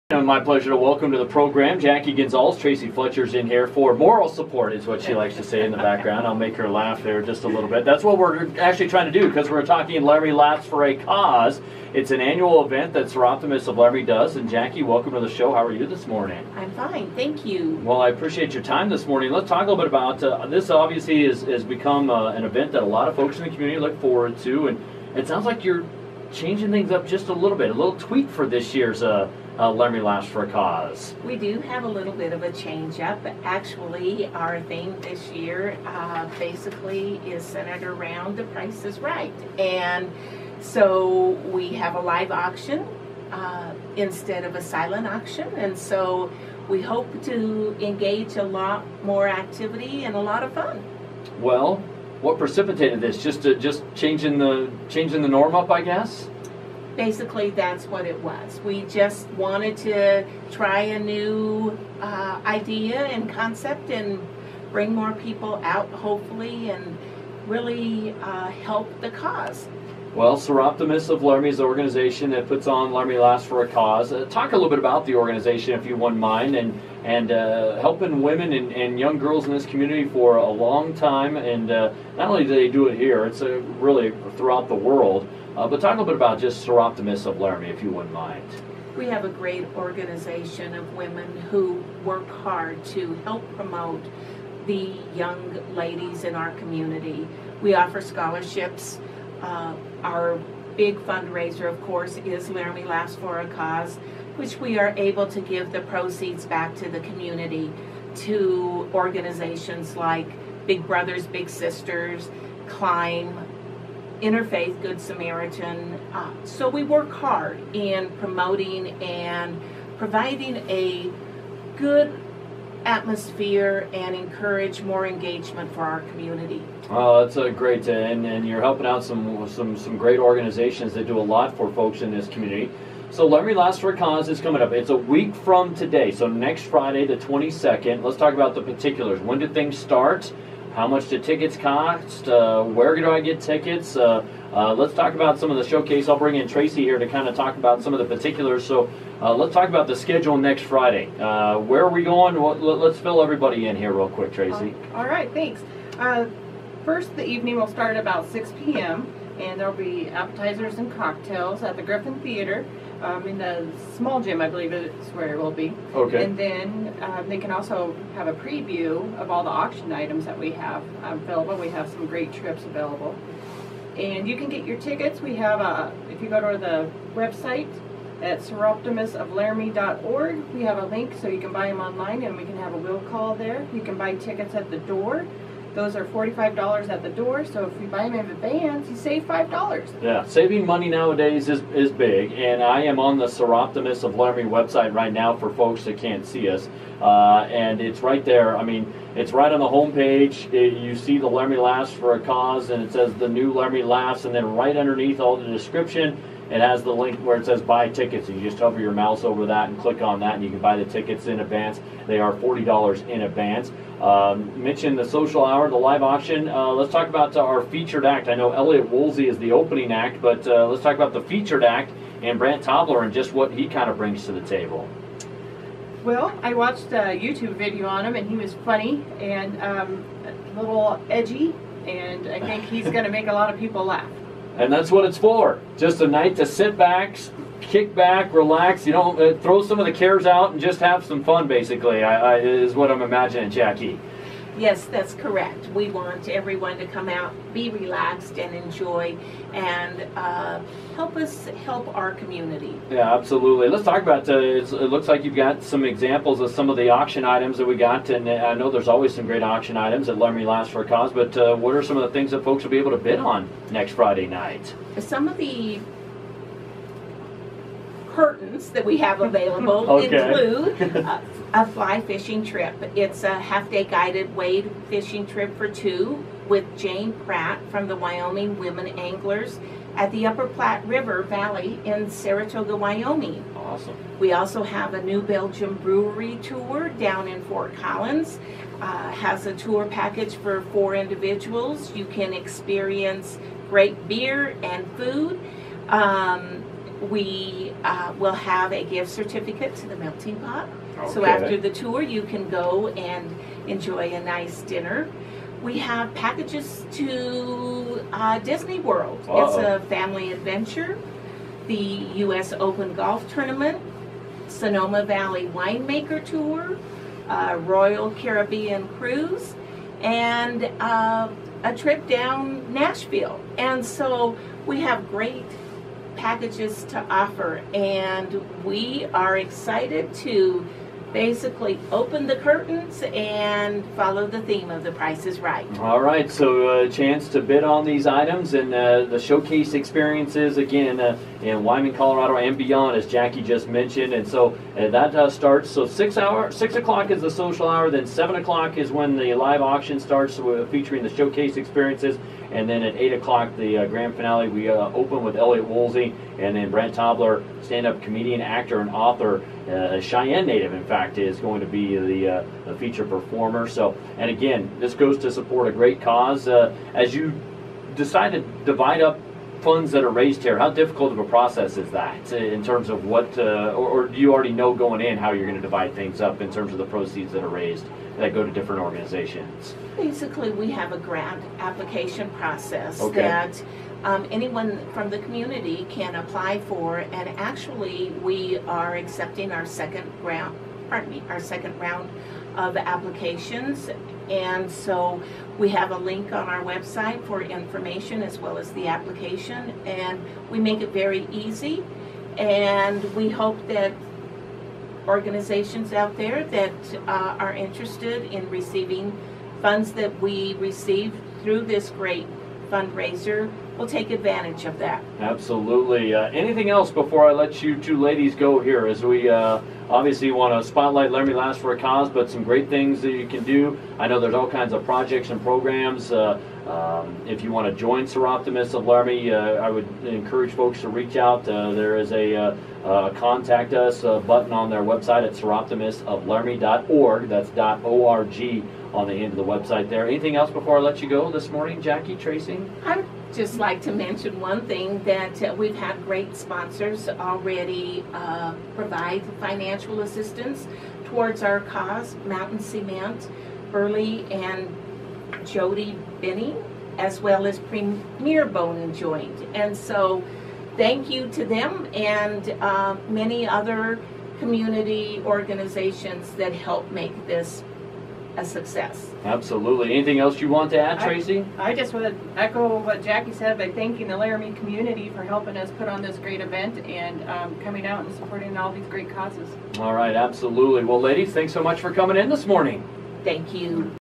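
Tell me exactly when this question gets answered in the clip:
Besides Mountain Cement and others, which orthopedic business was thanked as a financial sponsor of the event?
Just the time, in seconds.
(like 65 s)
457 s.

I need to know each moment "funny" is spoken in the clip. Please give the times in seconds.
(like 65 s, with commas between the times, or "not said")
228 s.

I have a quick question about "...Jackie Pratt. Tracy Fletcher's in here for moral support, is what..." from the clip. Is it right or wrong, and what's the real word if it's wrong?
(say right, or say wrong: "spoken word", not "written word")
wrong: "Gonzales", not "Pratt".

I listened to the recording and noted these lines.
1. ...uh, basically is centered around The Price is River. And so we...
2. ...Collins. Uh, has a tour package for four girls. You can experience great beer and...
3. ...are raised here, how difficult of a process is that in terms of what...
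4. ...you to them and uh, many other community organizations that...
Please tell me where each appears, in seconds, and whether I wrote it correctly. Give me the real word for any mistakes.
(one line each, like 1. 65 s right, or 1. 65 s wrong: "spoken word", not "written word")
1. 35 s wrong: "Right", not "River"
2. 287 s wrong: "individuals", not "girls"
3. 370 s right
4. 461 s right.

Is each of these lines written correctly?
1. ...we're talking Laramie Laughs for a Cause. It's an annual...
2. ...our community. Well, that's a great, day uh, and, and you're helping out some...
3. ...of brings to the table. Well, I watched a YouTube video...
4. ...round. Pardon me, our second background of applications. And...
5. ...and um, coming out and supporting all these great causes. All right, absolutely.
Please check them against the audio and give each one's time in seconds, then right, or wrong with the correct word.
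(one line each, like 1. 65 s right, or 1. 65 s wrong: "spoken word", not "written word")
1. 9 s right
2. 125 s right
3. 223 s right
4. 390 s wrong: "round", not "background"
5. 476 s right.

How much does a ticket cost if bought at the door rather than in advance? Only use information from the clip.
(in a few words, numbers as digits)
$45.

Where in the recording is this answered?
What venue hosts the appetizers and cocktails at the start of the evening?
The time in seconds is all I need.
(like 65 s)
161 s.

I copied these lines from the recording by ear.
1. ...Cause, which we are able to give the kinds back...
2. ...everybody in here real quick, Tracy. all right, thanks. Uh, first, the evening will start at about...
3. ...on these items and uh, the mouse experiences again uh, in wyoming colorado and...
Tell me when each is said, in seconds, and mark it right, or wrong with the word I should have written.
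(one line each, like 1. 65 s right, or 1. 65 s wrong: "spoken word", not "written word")
1. 103 s wrong: "proceeds", not "kinds"
2. 153 s right
3. 337 s wrong: "showcase", not "mouse".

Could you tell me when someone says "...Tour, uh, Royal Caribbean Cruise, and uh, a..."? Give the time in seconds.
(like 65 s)
316 s.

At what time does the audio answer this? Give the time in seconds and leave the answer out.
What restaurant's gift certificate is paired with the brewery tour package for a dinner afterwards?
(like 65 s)
299 s.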